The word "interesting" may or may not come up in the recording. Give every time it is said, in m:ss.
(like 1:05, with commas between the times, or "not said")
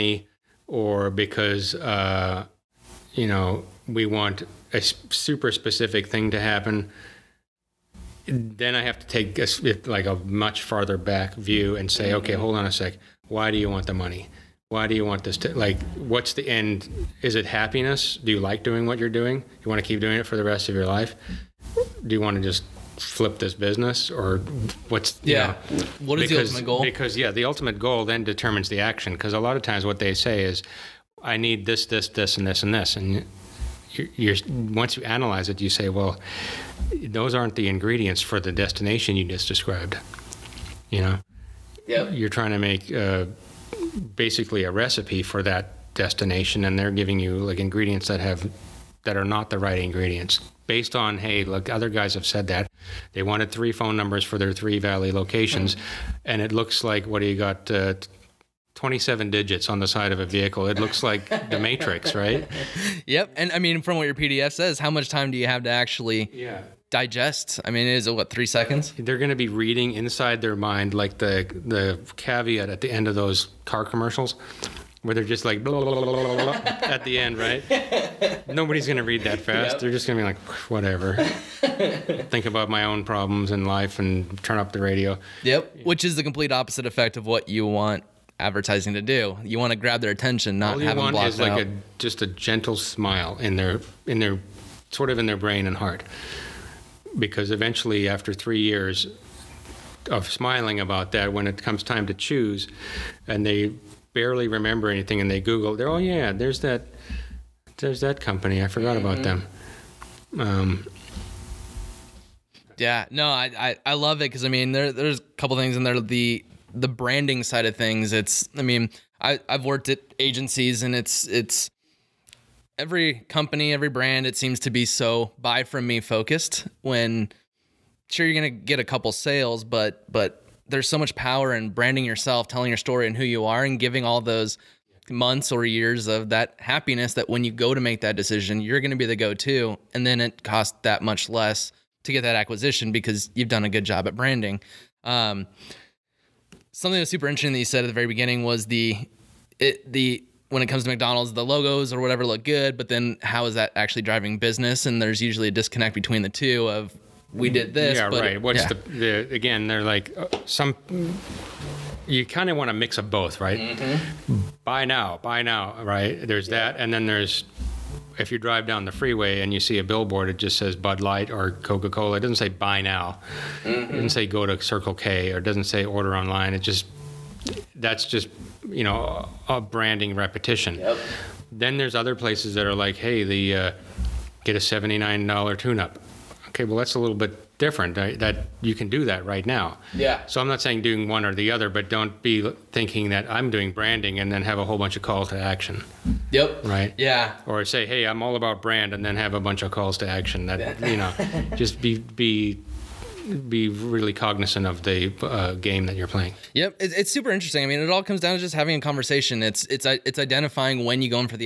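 2:27, 3:27.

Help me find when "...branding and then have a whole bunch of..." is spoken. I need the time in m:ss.
3:13.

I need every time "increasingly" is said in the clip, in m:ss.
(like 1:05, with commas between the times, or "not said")
not said.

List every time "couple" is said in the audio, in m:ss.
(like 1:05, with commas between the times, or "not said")
1:55, 2:08.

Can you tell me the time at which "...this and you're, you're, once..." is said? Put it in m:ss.
0:32.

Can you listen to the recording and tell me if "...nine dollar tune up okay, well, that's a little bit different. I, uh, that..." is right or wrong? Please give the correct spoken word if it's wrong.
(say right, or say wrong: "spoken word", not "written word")
right.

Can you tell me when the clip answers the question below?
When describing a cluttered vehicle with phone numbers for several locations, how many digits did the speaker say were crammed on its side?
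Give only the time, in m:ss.
0:58.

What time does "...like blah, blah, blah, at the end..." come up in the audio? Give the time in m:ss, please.
1:15.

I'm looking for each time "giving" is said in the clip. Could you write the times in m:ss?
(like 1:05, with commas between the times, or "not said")
0:46, 2:13.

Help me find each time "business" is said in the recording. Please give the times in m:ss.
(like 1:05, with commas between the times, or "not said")
0:23, 2:34.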